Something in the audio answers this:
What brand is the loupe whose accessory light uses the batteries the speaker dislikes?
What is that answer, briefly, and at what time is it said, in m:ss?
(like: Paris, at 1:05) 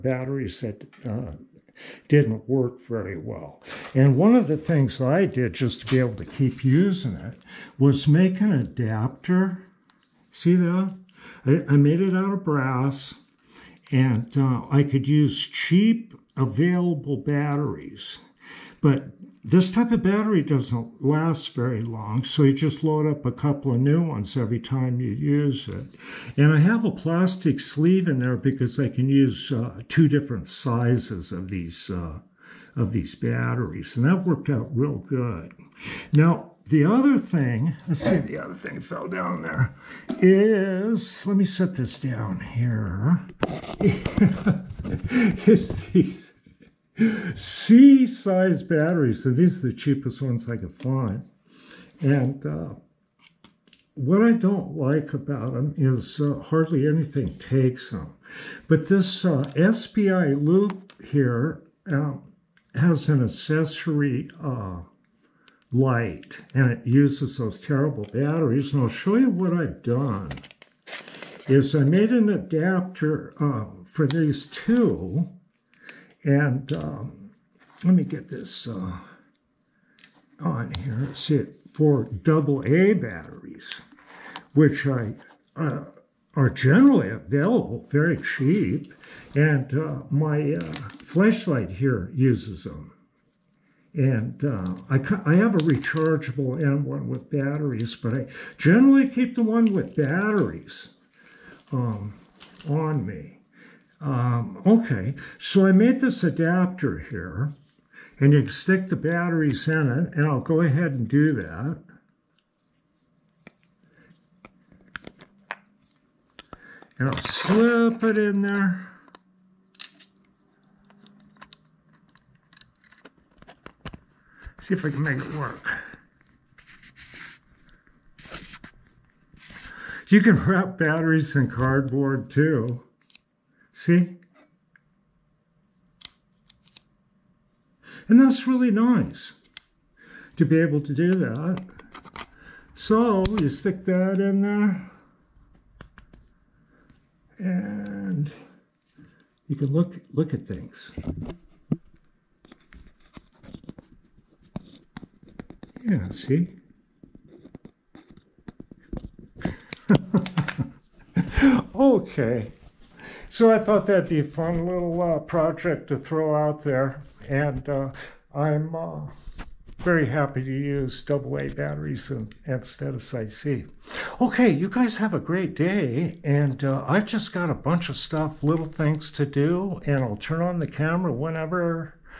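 SPI, at 0:59.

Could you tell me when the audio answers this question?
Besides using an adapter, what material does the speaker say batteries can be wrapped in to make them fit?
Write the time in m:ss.
2:11.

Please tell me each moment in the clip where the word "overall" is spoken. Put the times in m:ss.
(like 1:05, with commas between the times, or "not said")
not said.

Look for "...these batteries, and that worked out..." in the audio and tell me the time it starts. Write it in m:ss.
0:32.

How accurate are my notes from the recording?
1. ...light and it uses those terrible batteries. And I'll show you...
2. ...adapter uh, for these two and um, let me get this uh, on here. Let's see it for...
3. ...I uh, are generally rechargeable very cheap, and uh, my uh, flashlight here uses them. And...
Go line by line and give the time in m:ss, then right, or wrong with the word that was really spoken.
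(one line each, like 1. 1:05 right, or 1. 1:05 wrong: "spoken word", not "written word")
1. 1:05 right
2. 1:12 right
3. 1:24 wrong: "available", not "rechargeable".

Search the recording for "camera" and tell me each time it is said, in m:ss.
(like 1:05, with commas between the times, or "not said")
3:00.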